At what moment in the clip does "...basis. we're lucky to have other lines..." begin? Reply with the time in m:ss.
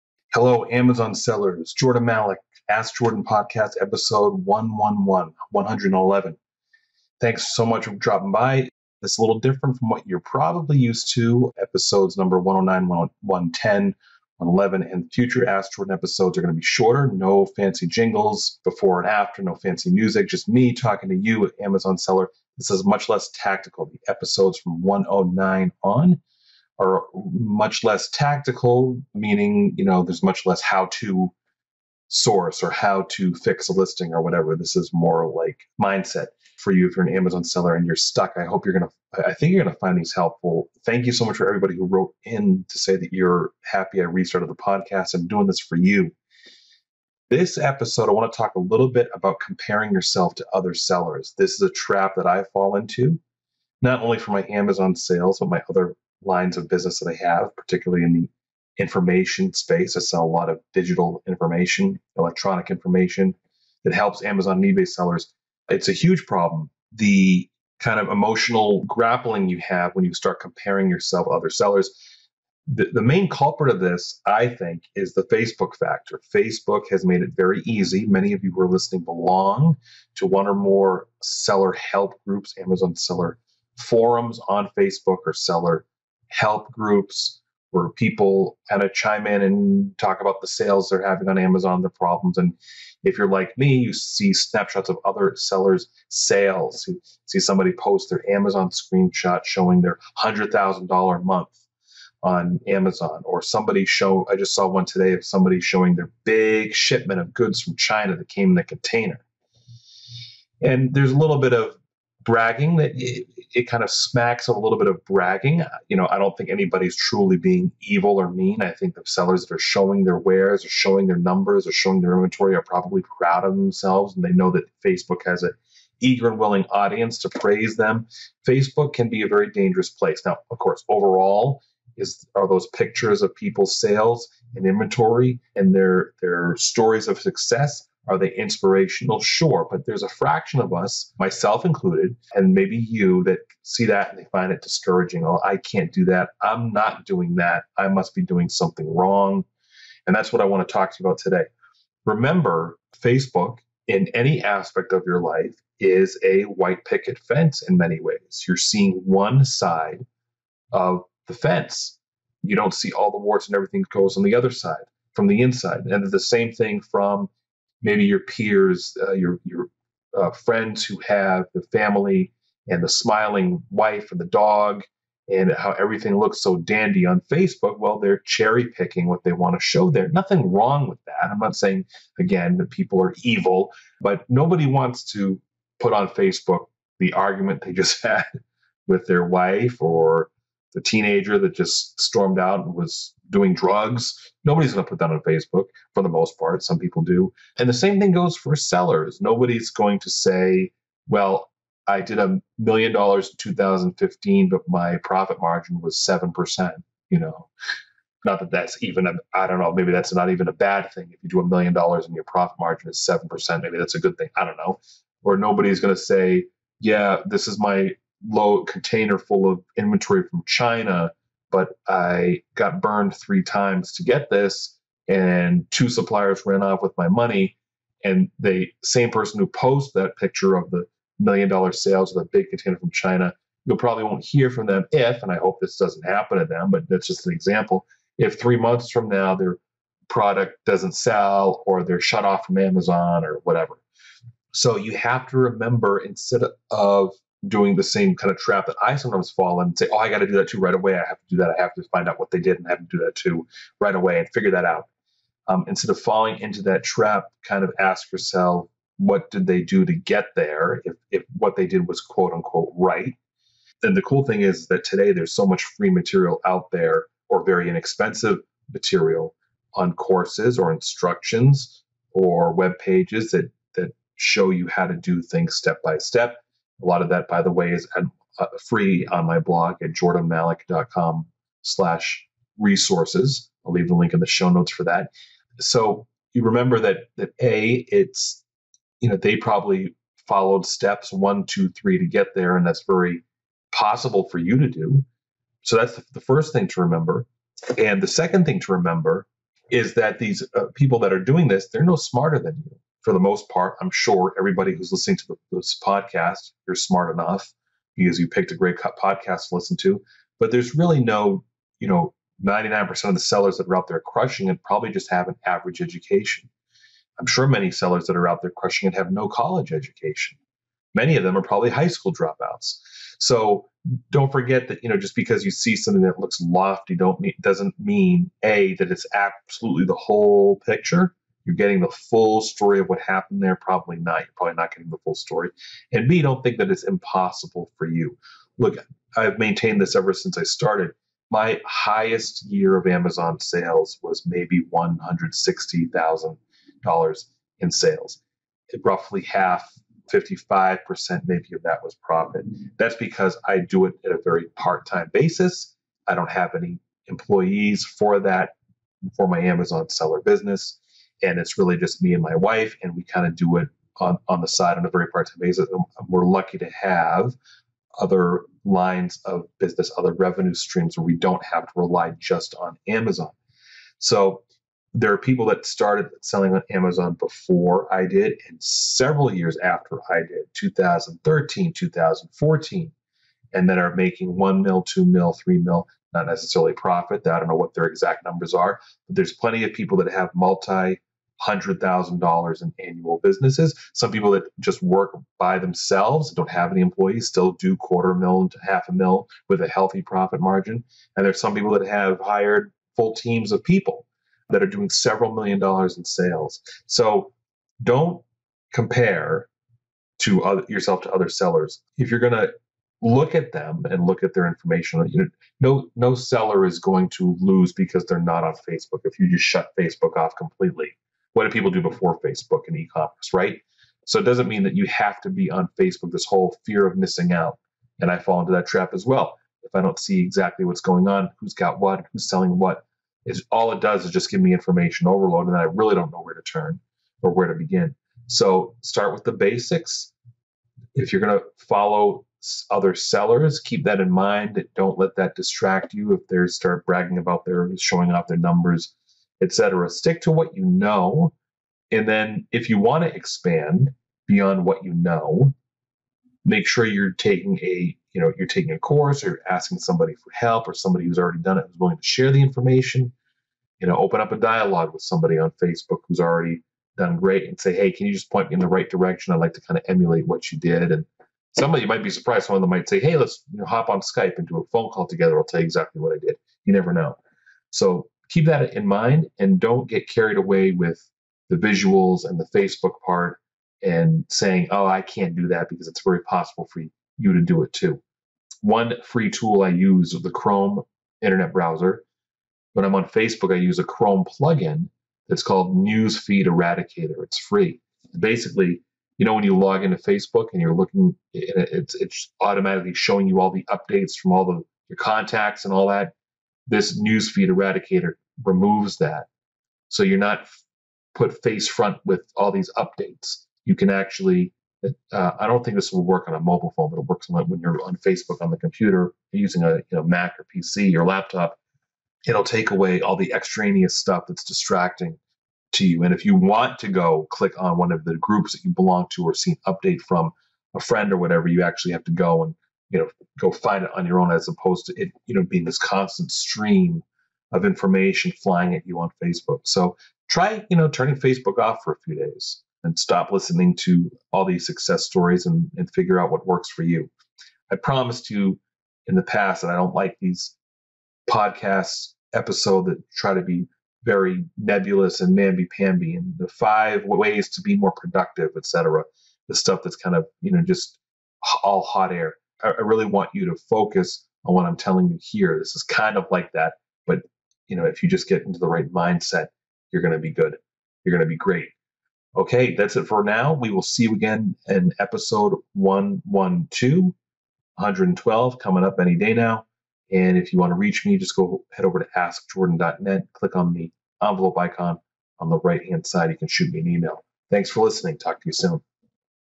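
6:05.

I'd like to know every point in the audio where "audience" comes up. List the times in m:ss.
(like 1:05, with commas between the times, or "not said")
2:06.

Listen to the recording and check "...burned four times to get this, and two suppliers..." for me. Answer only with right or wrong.
wrong.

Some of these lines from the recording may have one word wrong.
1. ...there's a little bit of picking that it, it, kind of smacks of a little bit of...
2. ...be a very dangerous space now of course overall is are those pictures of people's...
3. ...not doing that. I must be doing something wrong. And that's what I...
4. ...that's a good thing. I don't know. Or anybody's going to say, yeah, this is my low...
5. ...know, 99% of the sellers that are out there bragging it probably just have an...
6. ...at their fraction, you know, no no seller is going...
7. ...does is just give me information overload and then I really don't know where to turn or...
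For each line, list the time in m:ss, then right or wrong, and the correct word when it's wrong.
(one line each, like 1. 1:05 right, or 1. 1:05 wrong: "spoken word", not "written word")
1. 1:50 wrong: "bragging", not "picking"
2. 2:09 wrong: "place", not "space"
3. 2:26 right
4. 3:33 wrong: "nobody", not "anybody"
5. 5:11 wrong: "crushing", not "bragging"
6. 6:54 wrong: "information", not "fraction"
7. 7:13 right.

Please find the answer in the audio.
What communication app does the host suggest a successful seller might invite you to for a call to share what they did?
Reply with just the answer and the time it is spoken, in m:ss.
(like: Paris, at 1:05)
Skype, at 7:54.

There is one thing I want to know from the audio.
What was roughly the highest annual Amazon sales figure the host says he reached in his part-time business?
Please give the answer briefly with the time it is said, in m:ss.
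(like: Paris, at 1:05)
$160,000, at 5:44.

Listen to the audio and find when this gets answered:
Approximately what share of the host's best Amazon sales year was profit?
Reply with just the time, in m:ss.
5:50.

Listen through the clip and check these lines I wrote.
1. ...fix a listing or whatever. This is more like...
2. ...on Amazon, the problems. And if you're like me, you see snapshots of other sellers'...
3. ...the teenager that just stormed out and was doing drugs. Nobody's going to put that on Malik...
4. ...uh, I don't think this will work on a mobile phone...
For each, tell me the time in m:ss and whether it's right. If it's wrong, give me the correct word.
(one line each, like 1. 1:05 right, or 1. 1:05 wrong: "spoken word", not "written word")
1. 0:33 right
2. 1:31 right
3. 3:10 wrong: "Facebook", not "Malik"
4. 8:35 right.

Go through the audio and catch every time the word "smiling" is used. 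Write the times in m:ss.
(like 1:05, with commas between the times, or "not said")
2:52.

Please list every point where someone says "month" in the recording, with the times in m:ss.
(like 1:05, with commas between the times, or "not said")
1:41, 3:58.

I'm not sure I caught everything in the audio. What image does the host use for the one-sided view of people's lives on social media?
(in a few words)
white picket fence.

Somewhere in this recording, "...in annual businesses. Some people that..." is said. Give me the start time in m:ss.
6:32.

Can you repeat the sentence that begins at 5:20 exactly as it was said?
Many of them are probably high school dropouts.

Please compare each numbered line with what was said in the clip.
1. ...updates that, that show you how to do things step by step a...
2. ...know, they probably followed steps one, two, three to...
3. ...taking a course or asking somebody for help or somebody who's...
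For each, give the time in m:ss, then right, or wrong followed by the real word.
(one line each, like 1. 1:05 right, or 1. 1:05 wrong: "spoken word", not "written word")
1. 4:32 wrong: "pages", not "updates"
2. 4:49 right
3. 7:38 right.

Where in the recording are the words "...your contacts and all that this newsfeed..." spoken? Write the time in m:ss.
8:24.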